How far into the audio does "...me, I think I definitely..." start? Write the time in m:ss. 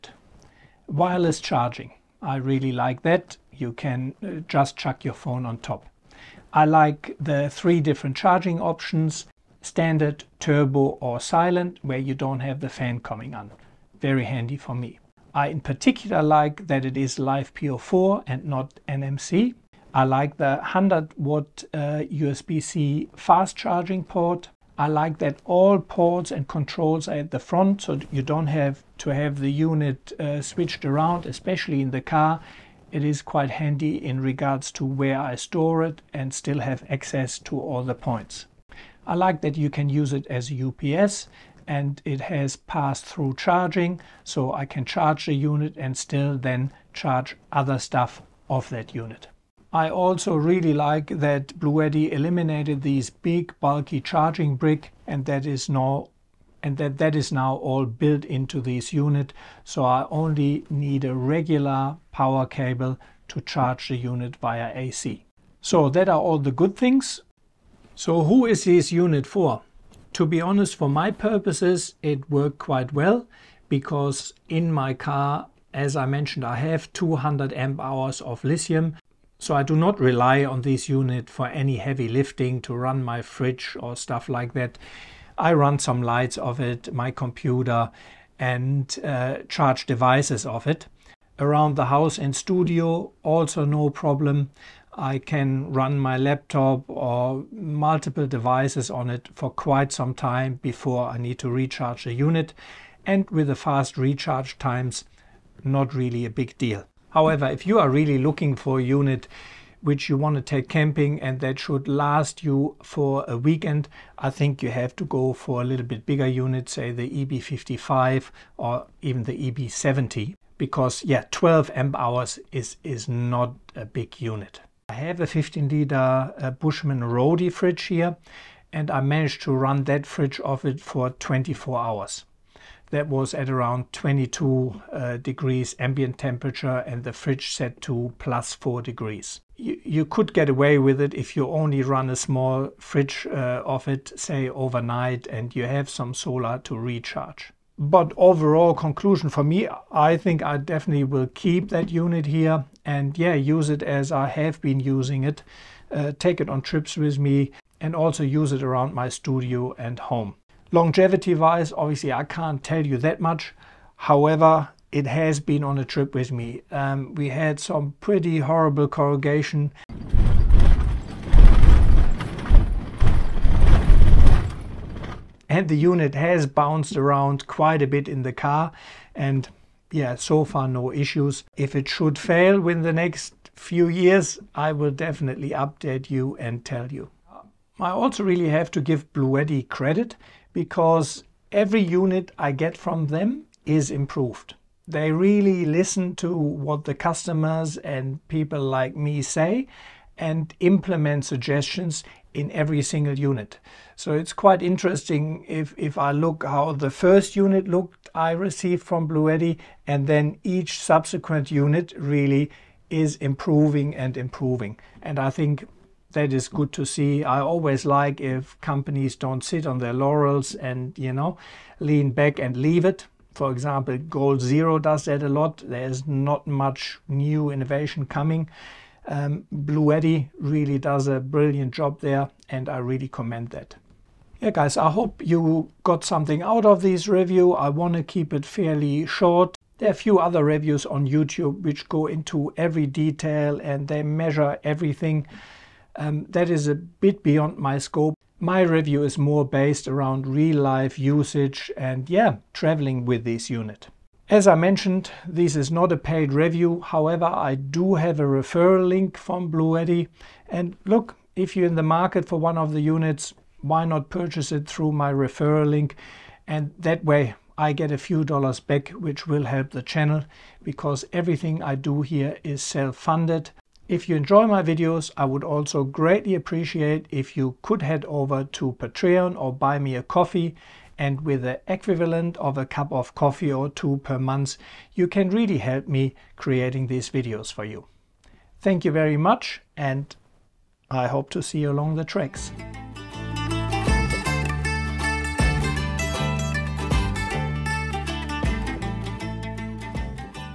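2:29.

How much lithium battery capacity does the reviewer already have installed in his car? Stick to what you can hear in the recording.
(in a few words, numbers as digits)
200 amp hours.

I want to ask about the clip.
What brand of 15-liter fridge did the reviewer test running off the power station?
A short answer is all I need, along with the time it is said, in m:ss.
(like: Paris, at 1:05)
Bushman Roadie, at 2:06.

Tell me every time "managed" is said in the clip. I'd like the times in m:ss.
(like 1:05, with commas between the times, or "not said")
2:08.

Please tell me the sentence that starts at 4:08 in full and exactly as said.
My review is more based around real life usage and yeah, traveling with this unit.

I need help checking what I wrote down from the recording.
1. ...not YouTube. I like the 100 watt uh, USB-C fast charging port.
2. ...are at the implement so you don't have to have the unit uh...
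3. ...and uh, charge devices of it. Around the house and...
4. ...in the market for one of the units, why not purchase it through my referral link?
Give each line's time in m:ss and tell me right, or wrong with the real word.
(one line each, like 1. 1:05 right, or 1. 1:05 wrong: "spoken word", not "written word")
1. 0:18 wrong: "NMC", not "YouTube"
2. 0:27 wrong: "front", not "implement"
3. 1:28 right
4. 4:21 right.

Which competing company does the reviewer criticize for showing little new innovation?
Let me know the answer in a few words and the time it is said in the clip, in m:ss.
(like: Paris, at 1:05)
Goal Zero, at 3:43.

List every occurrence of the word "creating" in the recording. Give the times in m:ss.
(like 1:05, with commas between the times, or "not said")
4:46.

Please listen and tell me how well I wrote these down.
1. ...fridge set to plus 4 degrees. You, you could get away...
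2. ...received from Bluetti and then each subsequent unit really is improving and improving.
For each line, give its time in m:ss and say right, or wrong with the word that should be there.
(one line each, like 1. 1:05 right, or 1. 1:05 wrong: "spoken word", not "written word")
1. 2:17 right
2. 3:28 right.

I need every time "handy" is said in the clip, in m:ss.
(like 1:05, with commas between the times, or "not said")
0:14, 0:33.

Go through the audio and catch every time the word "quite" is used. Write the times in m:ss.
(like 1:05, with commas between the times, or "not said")
0:33, 1:12, 1:39, 2:57, 3:24.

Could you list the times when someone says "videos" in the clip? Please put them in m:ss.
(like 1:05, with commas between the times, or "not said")
4:34, 4:47.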